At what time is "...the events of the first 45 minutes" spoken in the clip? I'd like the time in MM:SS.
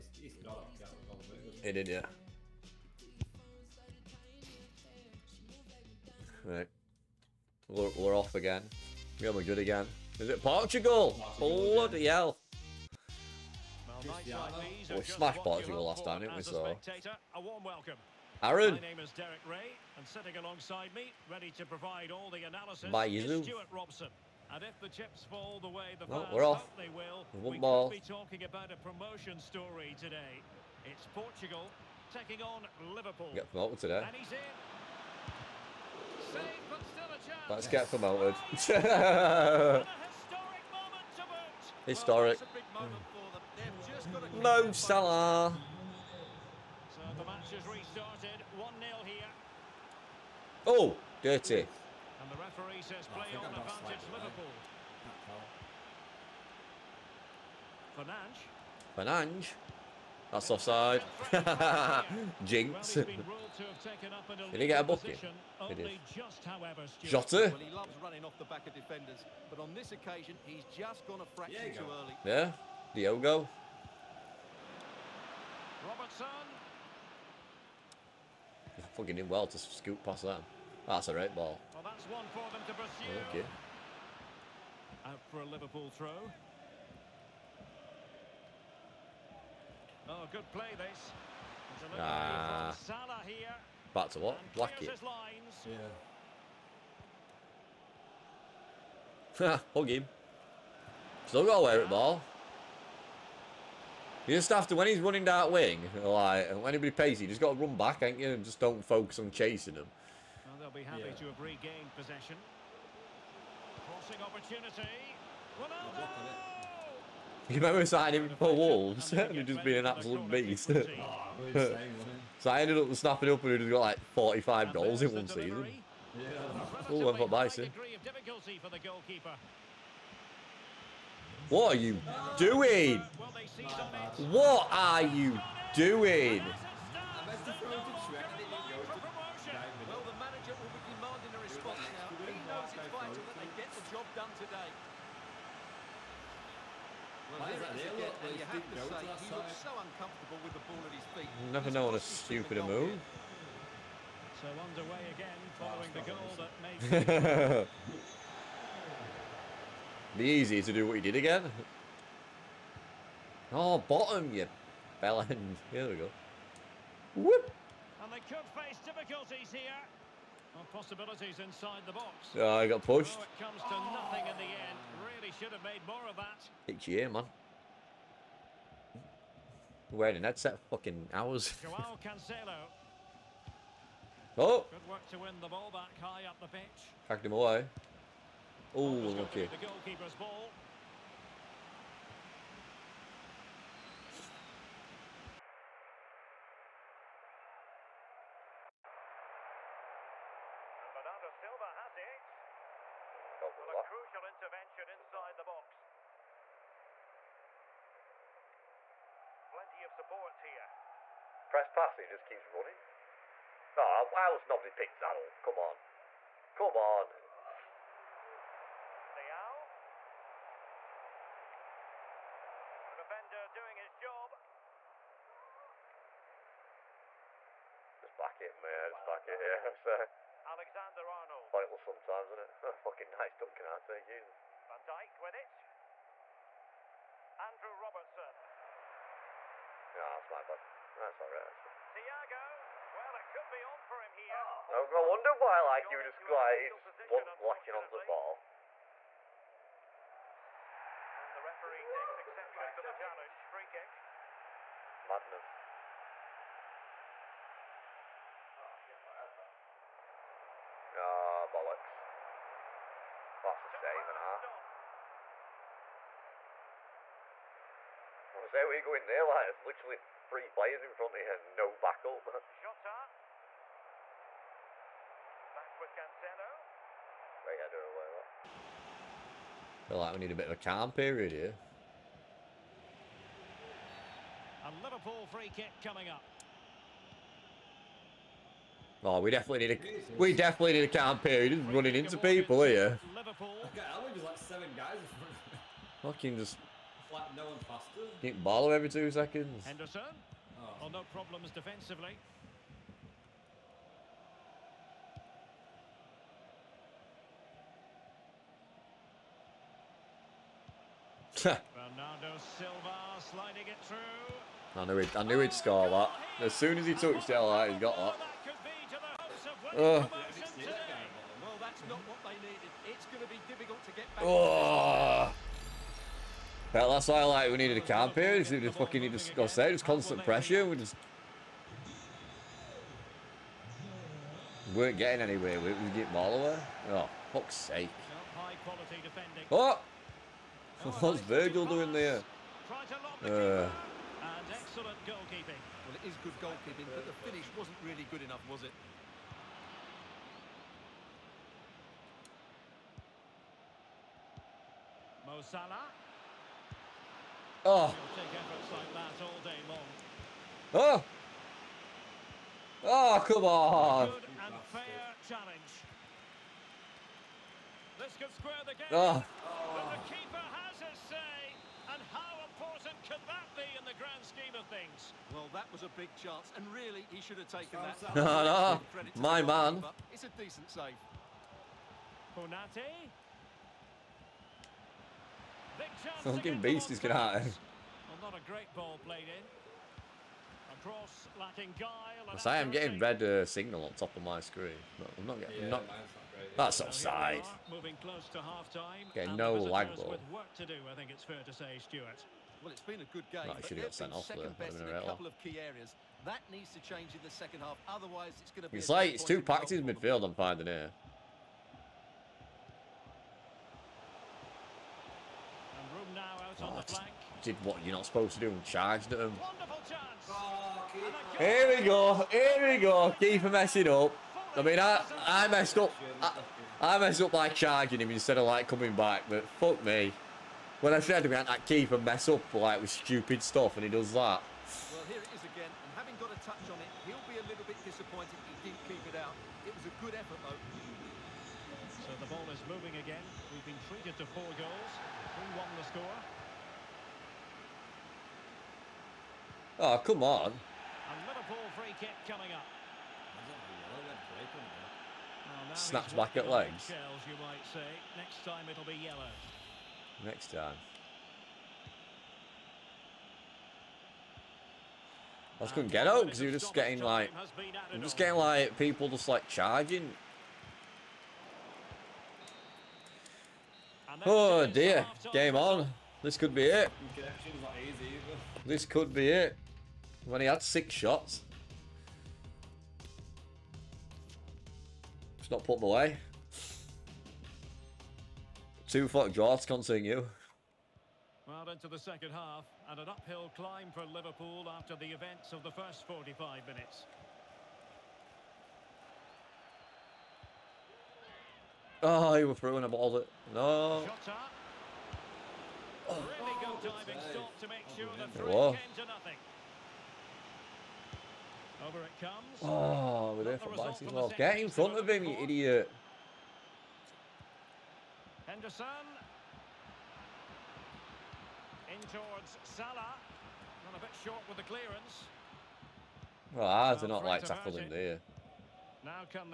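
08:14.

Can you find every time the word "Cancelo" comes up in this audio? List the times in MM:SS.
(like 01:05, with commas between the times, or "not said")
03:02, 04:35.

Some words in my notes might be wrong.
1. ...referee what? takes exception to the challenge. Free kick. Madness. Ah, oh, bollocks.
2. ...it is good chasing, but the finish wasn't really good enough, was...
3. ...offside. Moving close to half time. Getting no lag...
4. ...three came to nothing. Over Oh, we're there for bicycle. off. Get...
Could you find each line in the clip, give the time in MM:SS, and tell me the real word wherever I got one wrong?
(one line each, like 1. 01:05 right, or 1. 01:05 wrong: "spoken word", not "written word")
1. 04:11 right
2. 05:45 wrong: "goalkeeping", not "chasing"
3. 06:36 right
4. 08:28 right.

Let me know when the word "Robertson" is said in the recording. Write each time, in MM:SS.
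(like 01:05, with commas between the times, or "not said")
01:15, 03:57.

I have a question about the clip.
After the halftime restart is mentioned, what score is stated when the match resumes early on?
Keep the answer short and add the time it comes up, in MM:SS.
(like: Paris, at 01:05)
1-0, at 00:48.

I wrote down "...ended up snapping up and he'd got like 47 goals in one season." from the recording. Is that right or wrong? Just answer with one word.
wrong.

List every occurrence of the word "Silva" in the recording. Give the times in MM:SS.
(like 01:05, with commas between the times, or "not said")
03:21, 05:12.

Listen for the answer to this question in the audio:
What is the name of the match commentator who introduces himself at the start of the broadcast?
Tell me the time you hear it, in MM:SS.
00:19.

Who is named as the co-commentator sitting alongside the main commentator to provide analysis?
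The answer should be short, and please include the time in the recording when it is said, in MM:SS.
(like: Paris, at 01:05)
Stuart Robson, at 00:23.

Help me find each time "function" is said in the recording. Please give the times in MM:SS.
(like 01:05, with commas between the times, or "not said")
not said.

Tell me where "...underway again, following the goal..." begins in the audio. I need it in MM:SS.
02:34.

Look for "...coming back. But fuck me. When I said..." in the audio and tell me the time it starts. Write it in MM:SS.
07:08.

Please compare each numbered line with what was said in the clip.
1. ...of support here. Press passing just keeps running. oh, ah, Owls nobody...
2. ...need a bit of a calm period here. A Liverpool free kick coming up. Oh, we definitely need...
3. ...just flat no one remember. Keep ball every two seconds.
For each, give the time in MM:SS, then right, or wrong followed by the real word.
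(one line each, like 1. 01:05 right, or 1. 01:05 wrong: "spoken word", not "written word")
1. 03:29 right
2. 04:40 right
3. 04:56 wrong: "faster", not "remember".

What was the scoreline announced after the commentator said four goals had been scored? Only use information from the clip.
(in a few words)
3-1.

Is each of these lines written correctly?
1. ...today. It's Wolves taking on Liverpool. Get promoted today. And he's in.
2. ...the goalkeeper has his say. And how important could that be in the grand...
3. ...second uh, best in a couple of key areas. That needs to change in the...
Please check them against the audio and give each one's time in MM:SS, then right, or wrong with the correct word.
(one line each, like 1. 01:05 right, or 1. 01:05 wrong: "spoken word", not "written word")
1. 00:29 wrong: "Portugal", not "Wolves"
2. 06:09 wrong: "keeper", not "goalkeeper"
3. 06:44 right.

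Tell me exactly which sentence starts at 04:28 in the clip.
I say, where you going there?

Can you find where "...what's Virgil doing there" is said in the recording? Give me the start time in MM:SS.
05:41.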